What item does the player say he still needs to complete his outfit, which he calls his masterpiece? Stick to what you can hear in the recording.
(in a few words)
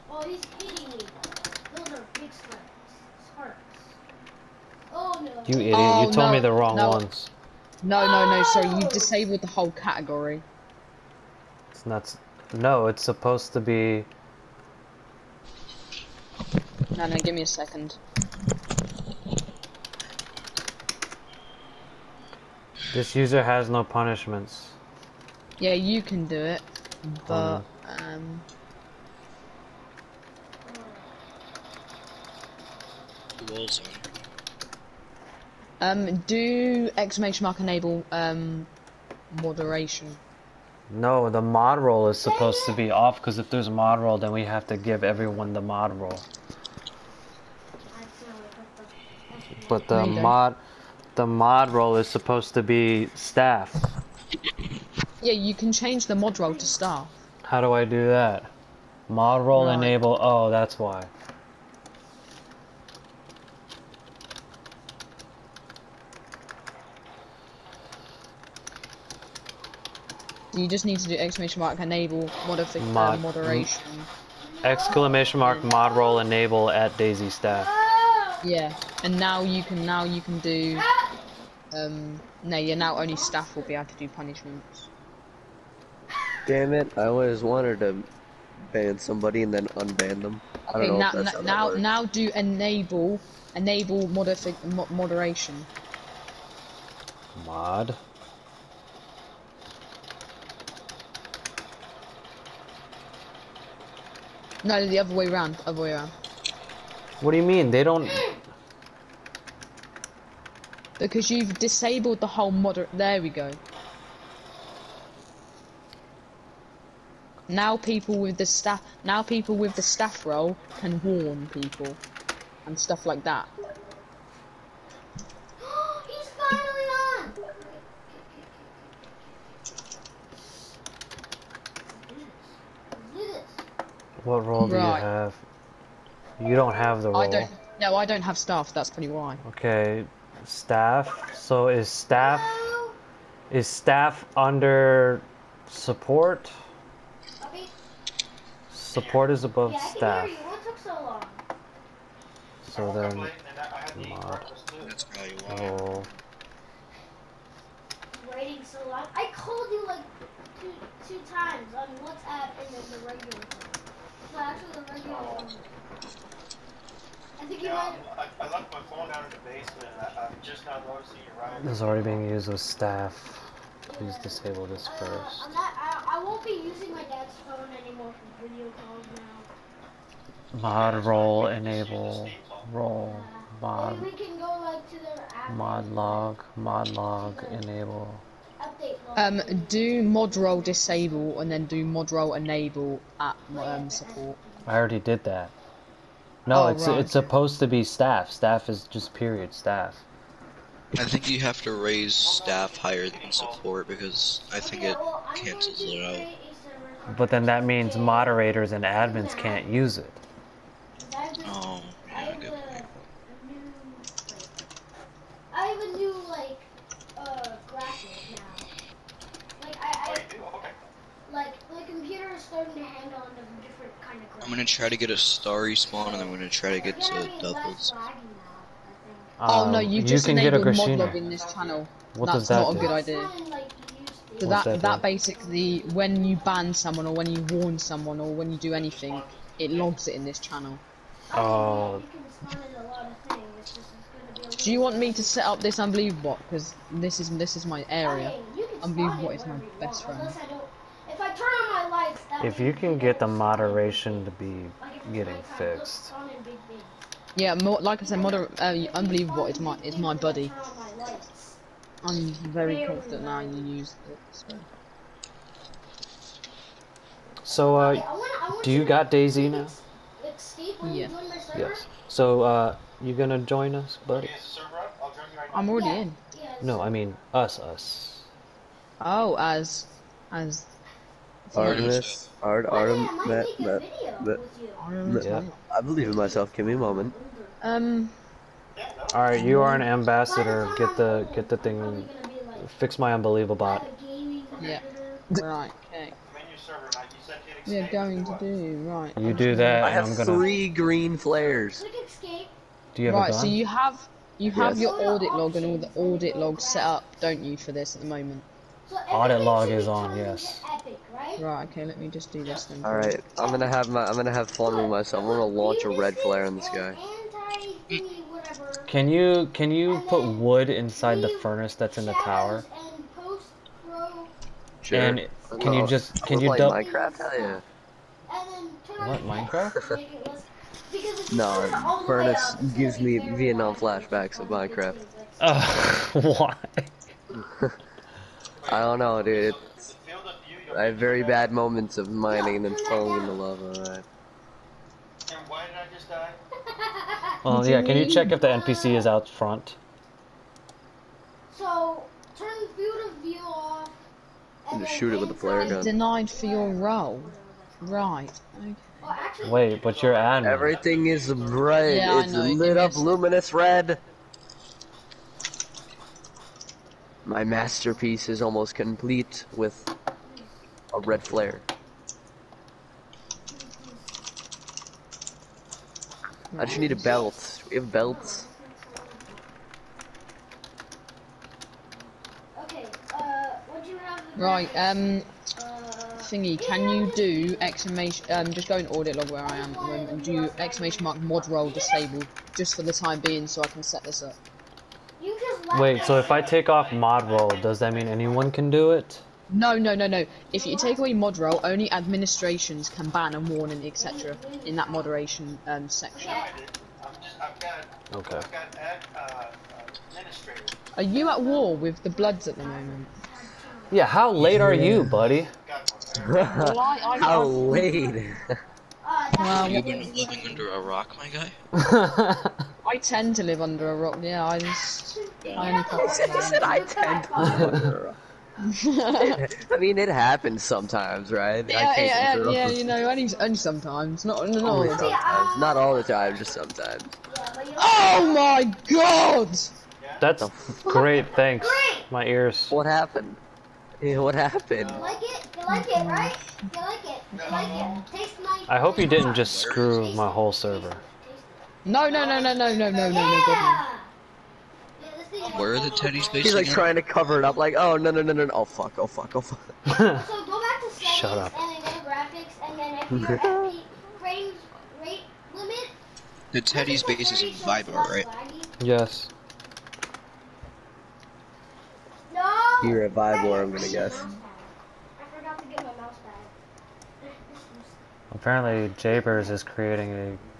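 a belt.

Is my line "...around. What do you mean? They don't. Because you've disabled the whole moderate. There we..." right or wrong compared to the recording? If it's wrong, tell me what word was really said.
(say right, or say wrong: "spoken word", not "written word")
right.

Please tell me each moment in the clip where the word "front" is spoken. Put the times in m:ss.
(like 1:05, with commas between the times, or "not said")
5:49.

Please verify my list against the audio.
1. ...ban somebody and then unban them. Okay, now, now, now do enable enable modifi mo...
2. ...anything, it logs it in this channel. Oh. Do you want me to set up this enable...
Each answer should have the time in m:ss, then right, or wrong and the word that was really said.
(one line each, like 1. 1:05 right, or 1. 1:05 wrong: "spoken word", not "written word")
1. 1:28 right
2. 3:58 wrong: "unbelievable", not "enable".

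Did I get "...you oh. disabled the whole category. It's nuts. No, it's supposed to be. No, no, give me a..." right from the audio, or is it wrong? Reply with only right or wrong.
right.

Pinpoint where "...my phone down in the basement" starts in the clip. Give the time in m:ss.
2:48.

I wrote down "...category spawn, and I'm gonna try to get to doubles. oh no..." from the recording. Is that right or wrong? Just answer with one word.
wrong.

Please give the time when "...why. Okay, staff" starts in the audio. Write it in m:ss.
2:19.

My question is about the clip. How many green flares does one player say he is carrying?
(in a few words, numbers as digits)
3.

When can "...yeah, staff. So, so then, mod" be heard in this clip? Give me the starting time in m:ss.
2:29.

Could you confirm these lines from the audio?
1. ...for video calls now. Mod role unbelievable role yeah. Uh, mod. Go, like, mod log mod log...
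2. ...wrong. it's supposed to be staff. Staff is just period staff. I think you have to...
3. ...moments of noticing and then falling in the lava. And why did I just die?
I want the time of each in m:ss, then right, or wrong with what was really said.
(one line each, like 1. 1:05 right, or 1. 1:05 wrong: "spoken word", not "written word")
1. 2:58 wrong: "enable", not "unbelievable"
2. 3:16 right
3. 5:41 wrong: "mining", not "noticing".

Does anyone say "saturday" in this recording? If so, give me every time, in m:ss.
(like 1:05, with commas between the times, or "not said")
not said.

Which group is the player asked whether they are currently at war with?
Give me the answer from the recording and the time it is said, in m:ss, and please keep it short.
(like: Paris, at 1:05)
the Bloods, at 6:50.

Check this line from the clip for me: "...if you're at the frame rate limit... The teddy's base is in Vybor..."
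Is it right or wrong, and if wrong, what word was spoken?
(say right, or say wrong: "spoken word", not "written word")
right.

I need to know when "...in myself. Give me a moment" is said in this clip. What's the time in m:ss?
4:46.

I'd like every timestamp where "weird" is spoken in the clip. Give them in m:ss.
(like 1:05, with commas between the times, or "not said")
not said.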